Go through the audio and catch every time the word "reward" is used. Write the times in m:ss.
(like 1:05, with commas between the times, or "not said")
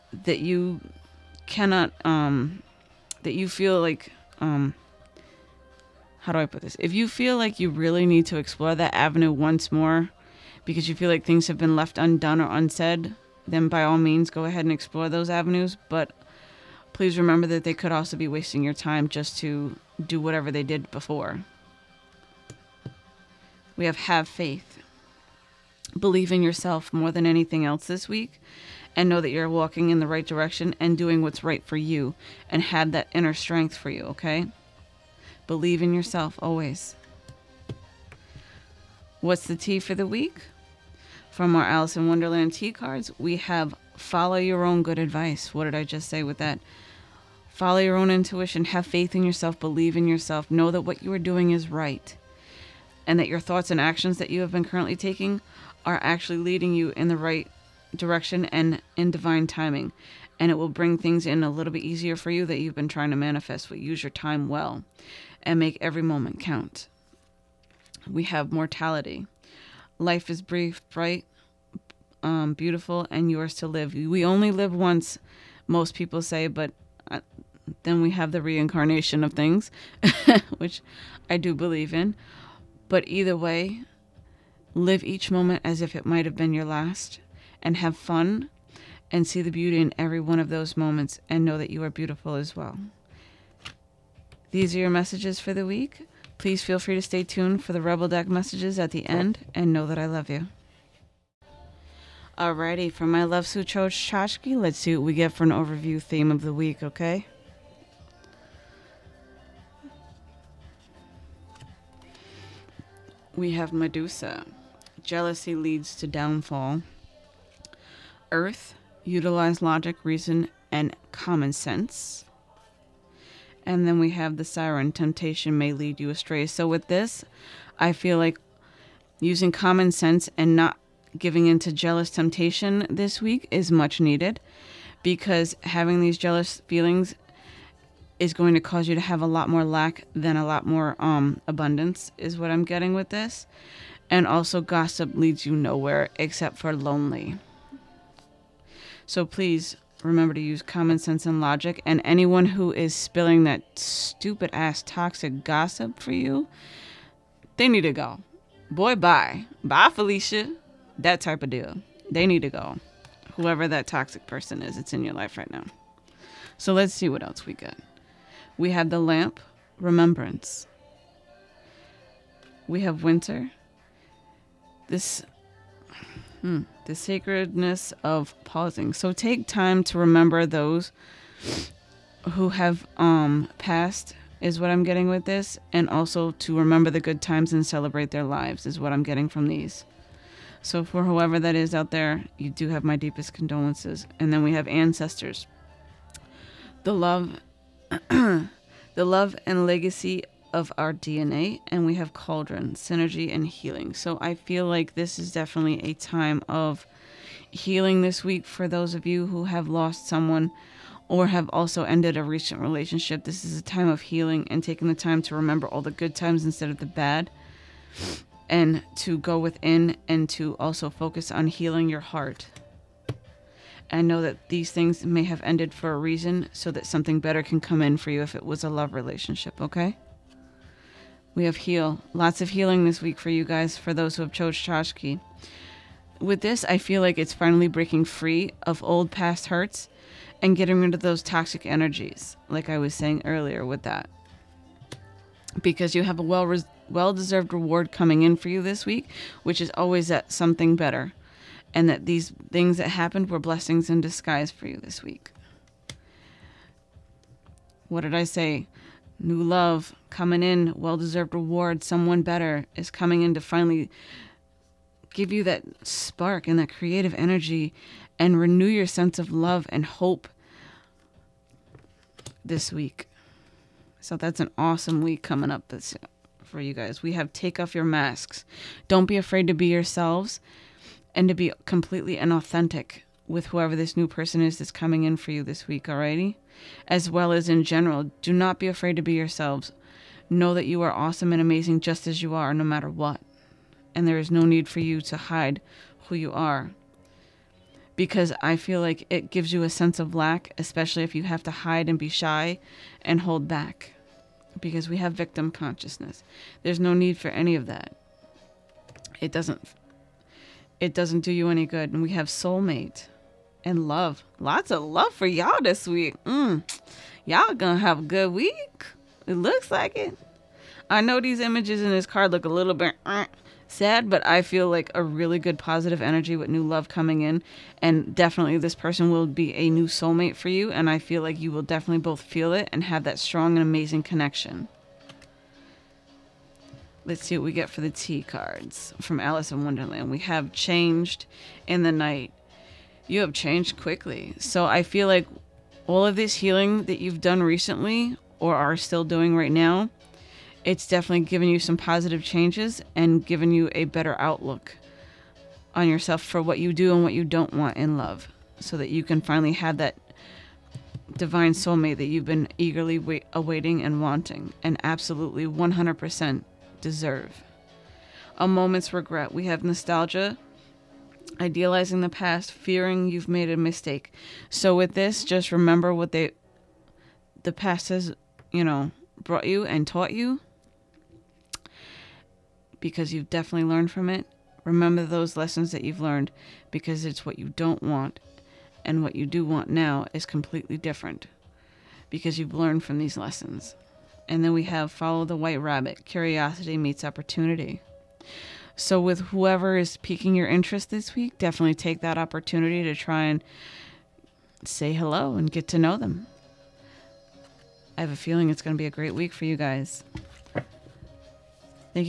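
4:07, 4:21.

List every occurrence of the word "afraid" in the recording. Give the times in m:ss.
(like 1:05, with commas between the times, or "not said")
4:39, 4:48.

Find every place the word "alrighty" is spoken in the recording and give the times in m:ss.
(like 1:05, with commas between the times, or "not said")
1:42, 4:45.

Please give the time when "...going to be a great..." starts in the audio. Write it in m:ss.
6:48.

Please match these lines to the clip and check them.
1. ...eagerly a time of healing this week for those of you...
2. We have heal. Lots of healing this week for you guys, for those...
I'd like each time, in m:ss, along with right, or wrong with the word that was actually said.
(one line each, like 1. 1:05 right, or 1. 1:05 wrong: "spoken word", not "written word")
1. 3:25 wrong: "definitely", not "eagerly"
2. 3:51 right.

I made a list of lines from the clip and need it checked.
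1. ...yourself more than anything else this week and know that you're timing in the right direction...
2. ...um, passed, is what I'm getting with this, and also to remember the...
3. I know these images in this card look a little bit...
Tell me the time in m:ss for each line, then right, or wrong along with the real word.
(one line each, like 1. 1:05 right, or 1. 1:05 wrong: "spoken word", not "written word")
1. 0:26 wrong: "walking", not "timing"
2. 3:02 right
3. 5:20 right.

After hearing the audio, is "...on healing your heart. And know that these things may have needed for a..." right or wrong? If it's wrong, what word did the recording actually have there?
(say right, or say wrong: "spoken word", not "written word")
wrong: "ended", not "needed".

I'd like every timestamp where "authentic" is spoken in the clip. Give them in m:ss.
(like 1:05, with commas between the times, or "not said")
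4:42.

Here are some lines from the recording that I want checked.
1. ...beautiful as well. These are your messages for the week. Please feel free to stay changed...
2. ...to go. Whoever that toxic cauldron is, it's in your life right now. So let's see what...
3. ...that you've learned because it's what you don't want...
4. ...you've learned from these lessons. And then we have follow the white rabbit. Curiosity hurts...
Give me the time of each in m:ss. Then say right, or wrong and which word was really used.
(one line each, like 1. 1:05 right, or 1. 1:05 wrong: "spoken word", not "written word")
1. 1:31 wrong: "tuned", not "changed"
2. 2:42 wrong: "person", not "cauldron"
3. 6:25 right
4. 6:32 wrong: "meets", not "hurts".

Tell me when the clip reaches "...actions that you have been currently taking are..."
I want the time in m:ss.
0:53.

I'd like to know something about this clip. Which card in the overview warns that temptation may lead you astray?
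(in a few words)
The siren.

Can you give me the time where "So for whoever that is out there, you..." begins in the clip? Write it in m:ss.
3:10.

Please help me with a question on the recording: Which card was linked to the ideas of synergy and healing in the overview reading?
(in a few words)
Cauldron.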